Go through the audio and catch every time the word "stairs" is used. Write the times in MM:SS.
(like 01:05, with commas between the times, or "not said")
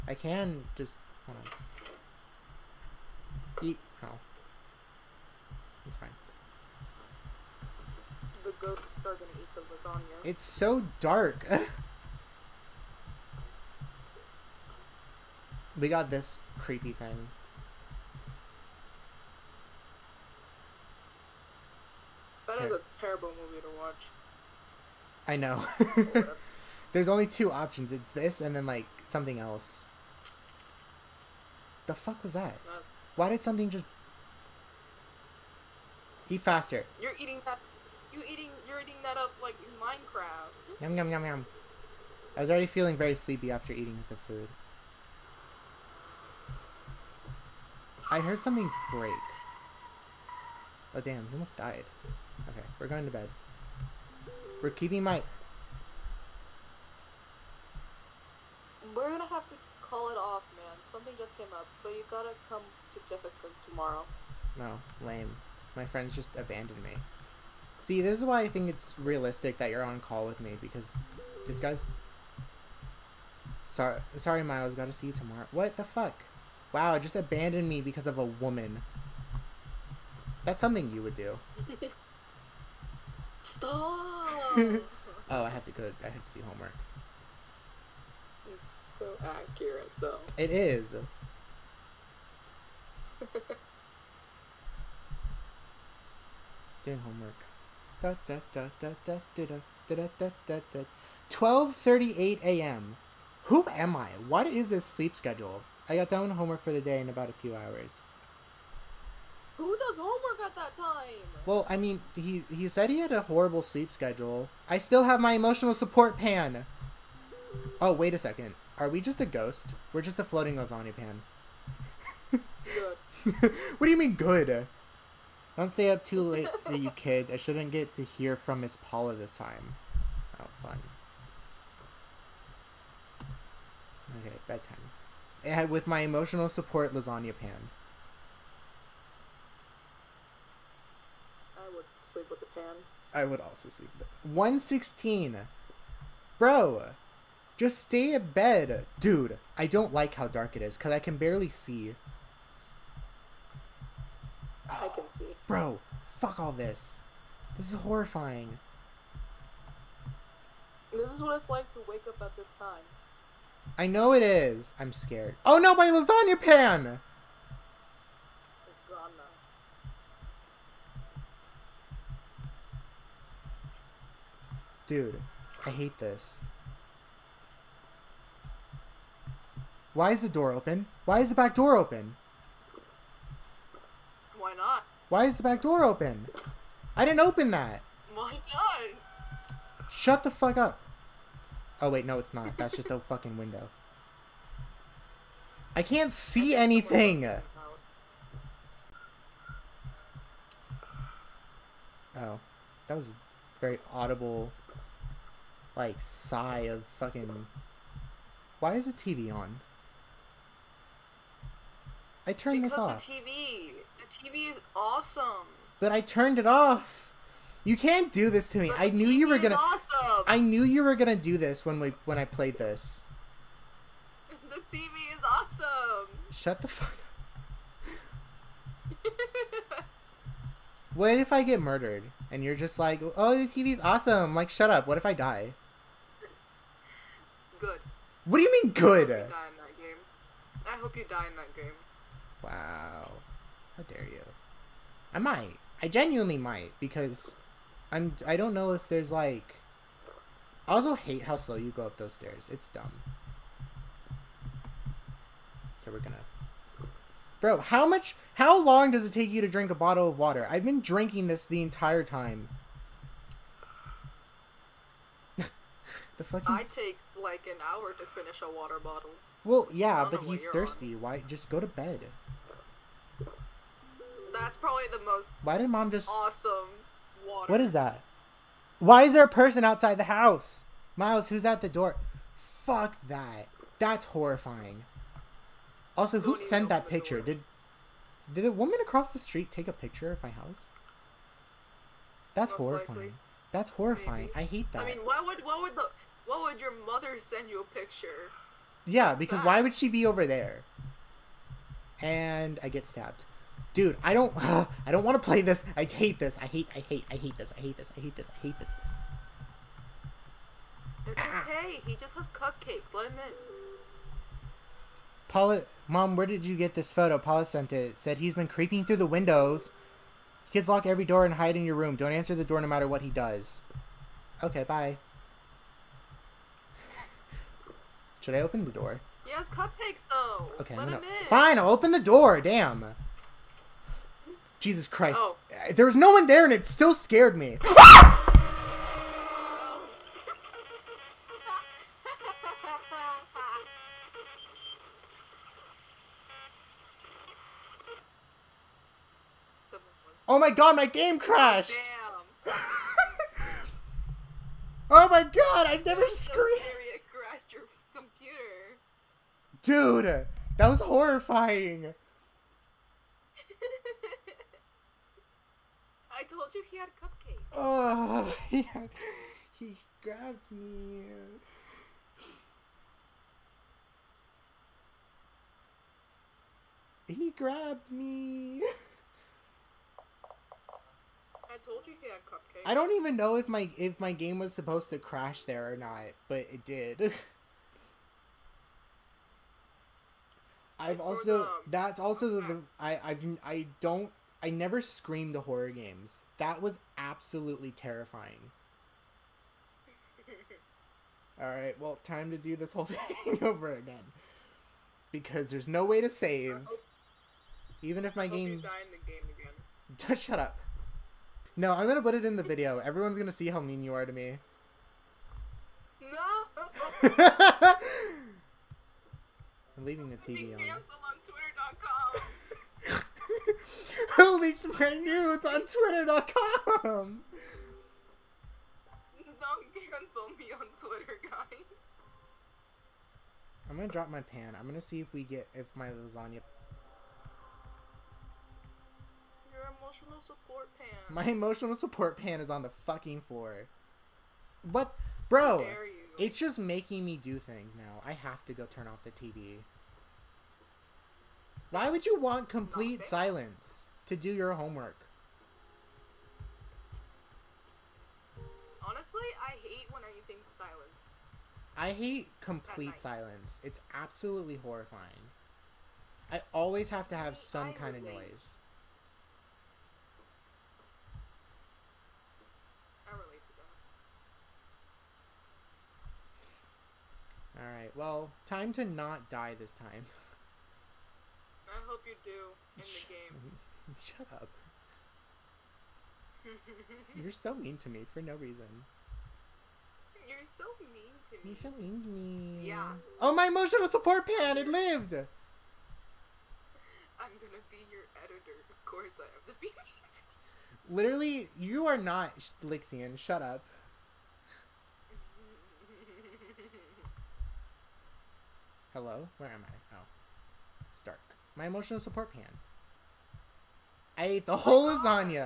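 04:12.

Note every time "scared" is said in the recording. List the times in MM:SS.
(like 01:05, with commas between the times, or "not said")
02:44, 05:36.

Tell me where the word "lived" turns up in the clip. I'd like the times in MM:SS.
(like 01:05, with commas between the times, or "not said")
08:14.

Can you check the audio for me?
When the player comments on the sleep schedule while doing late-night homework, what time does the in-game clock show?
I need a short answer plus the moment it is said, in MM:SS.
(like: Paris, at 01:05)
12:38 a.m., at 01:41.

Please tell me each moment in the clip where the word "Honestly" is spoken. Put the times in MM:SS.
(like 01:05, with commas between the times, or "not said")
07:38.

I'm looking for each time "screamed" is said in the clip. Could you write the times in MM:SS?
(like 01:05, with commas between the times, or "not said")
05:56, 06:34.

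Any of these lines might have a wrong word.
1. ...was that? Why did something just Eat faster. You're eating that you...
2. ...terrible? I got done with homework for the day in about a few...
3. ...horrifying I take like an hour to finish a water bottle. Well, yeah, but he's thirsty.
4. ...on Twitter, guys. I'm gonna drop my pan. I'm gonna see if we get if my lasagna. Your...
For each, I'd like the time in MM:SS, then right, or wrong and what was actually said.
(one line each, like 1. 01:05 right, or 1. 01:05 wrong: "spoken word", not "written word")
1. 00:32 right
2. 01:45 wrong: "schedule", not "terrible"
3. 04:26 wrong: "fucking", not "horrifying"
4. 07:10 right.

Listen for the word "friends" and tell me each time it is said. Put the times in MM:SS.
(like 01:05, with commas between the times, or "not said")
01:05.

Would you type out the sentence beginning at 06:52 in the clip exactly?
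Everyone's gonna see how mean you are to me.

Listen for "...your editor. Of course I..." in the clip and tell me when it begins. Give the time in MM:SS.
08:17.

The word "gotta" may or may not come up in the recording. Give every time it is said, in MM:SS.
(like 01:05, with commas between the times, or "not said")
01:02, 01:14.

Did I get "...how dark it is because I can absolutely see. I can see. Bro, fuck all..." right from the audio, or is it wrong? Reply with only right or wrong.
wrong.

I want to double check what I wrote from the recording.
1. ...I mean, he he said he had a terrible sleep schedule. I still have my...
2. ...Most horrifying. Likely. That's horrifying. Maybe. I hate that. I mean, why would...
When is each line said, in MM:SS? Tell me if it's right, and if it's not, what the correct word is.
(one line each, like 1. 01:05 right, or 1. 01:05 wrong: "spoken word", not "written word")
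1. 01:51 wrong: "horrible", not "terrible"
2. 04:52 right.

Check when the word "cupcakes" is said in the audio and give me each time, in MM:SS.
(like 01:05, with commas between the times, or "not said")
05:12, 05:29, 06:06, 06:22.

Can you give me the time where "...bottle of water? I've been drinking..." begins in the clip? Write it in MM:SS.
04:19.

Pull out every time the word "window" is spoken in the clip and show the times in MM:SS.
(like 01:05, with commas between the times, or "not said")
03:13, 05:19.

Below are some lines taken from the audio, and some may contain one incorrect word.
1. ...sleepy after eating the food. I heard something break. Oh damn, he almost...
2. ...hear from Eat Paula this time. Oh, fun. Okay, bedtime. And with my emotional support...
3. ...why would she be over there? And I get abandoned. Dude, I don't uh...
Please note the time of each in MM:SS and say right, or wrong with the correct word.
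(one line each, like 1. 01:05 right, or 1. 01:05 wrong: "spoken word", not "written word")
1. 00:43 right
2. 02:08 wrong: "Miss", not "Eat"
3. 04:59 wrong: "stabbed", not "abandoned".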